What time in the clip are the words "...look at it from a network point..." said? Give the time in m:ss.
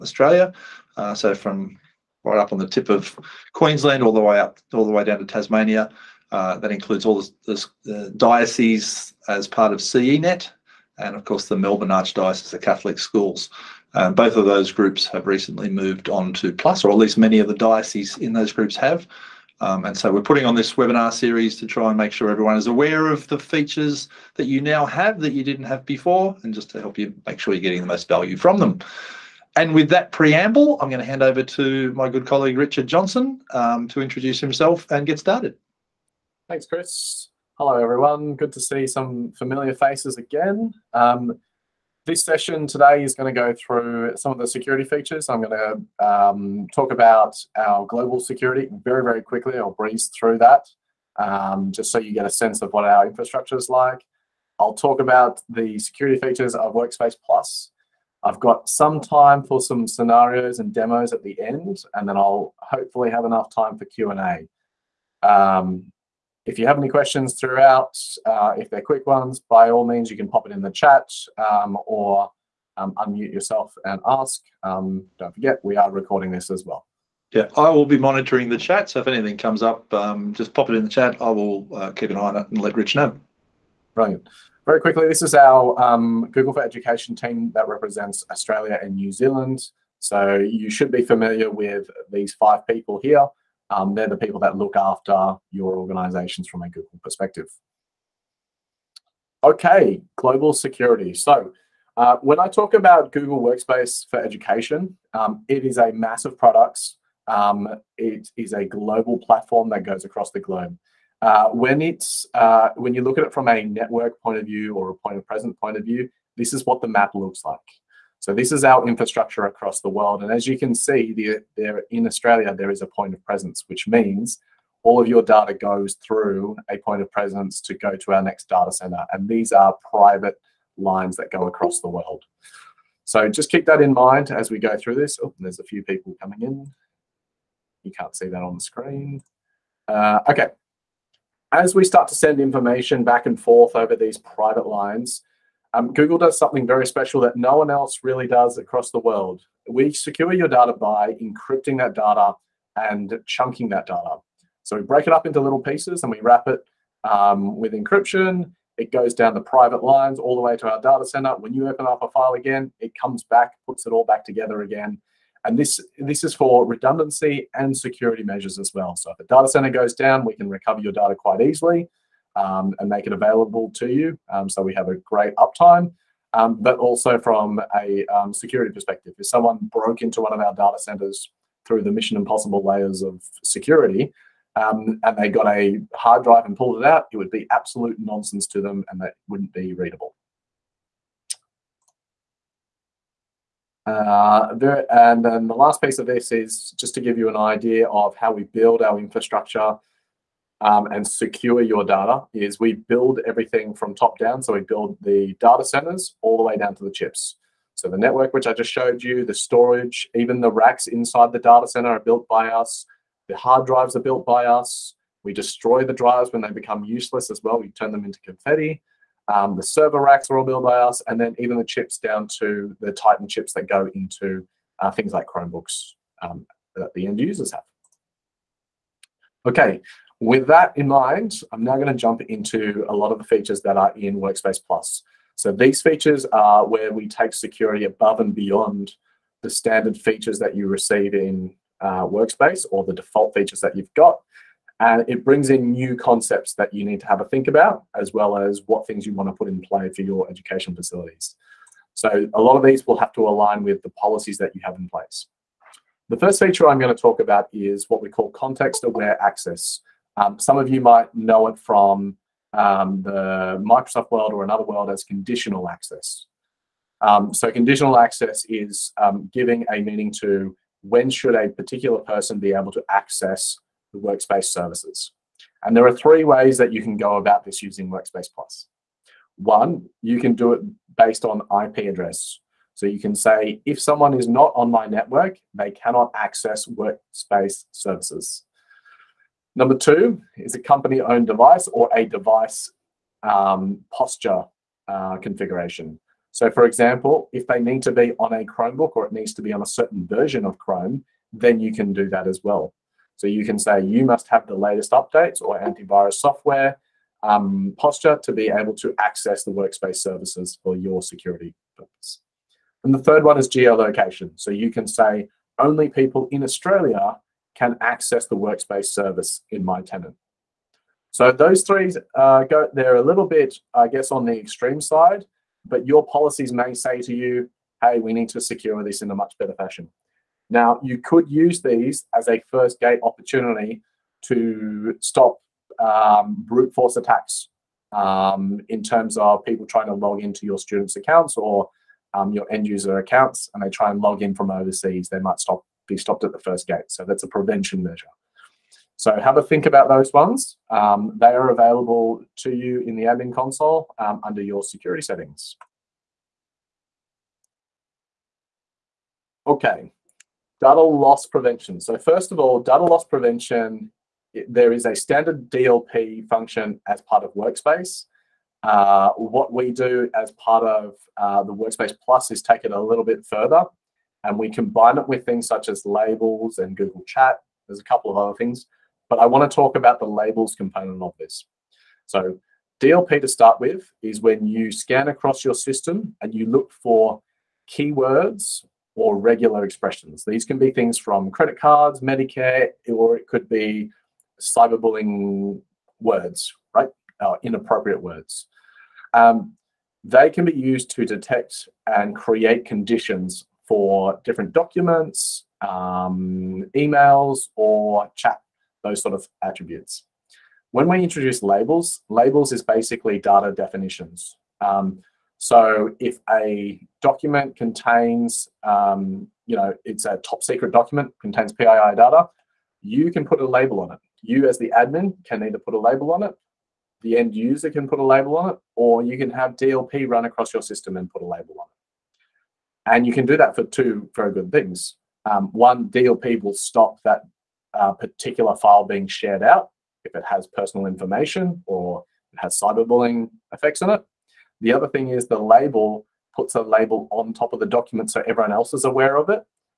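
1:53.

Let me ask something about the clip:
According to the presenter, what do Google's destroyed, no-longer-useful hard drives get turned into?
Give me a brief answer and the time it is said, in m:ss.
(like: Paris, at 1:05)
Confetti, at 3:38.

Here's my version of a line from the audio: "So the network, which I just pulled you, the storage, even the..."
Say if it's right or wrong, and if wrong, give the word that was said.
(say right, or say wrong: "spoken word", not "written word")
wrong: "showed", not "pulled".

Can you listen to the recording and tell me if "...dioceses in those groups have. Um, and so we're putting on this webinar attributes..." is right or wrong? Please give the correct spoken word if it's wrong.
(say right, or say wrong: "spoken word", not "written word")
wrong: "series", not "attributes".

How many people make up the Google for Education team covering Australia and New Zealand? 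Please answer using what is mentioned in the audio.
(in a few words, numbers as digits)
5.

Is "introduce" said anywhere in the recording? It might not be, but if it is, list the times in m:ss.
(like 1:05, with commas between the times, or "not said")
0:34, 6:51.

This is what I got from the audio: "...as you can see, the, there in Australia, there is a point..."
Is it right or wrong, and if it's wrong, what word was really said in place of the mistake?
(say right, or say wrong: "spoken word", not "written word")
right.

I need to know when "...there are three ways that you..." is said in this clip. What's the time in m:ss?
4:35.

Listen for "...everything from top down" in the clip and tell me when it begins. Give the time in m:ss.
3:23.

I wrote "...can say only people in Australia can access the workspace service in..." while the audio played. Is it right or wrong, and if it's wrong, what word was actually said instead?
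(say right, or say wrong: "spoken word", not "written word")
right.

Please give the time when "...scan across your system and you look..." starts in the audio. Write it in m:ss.
6:24.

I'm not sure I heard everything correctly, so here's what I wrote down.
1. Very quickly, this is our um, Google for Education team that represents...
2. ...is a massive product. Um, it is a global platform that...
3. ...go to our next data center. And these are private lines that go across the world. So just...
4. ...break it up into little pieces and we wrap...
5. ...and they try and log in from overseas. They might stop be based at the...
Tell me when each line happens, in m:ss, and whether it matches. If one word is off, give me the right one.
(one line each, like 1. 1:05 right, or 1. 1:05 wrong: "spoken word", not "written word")
1. 1:24 right
2. 1:45 right
3. 2:07 right
4. 2:34 right
5. 5:43 wrong: "stopped", not "based".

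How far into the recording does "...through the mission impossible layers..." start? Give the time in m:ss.
3:01.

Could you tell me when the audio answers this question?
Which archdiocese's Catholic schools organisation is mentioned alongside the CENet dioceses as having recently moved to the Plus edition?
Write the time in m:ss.
0:11.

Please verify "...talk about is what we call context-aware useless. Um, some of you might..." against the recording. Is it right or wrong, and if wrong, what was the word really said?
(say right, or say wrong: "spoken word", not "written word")
wrong: "access", not "useless".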